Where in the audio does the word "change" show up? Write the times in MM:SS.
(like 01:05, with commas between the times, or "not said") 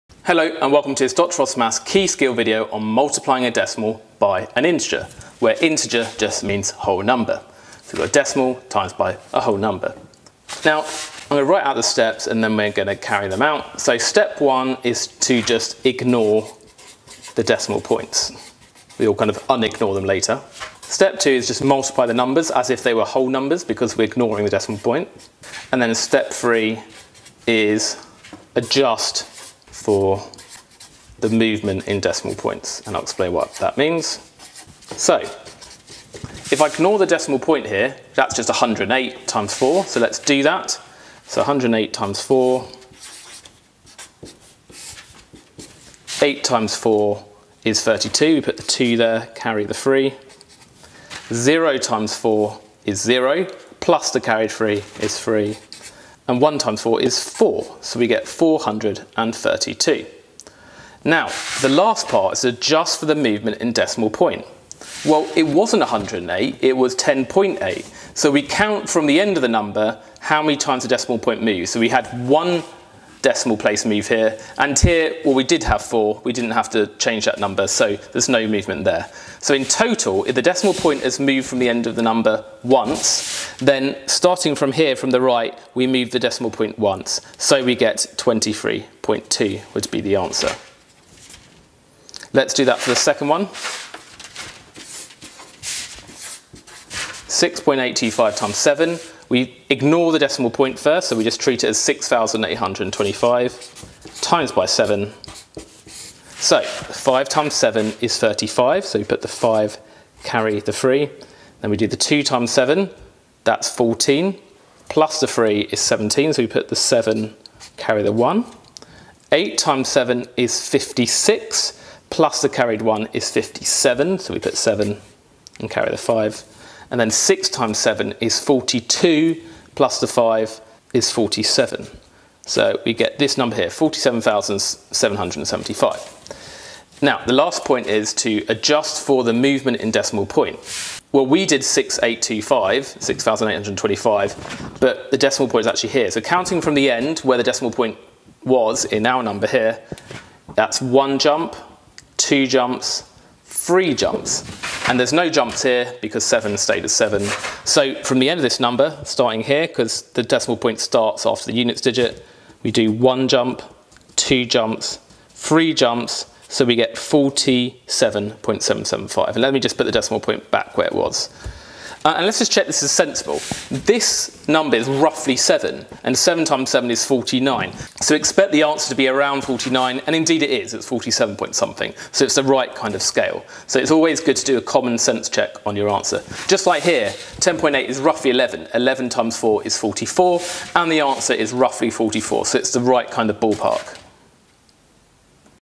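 01:16.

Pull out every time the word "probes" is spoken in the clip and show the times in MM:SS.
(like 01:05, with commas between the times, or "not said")
not said.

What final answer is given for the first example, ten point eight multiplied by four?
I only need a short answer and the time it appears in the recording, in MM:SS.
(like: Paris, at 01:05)
23.2, at 01:28.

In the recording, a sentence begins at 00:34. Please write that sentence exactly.
So, if I ignore the decimal point here, that's just 108 times 4, so let's do that.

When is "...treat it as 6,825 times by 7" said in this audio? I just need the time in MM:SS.
01:41.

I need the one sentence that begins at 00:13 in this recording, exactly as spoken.
So step one is to just ignore the decimal points.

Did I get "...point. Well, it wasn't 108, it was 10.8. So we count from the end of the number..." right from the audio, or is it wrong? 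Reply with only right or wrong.
right.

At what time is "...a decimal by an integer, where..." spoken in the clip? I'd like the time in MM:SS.
00:03.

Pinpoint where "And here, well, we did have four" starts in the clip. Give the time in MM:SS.
01:14.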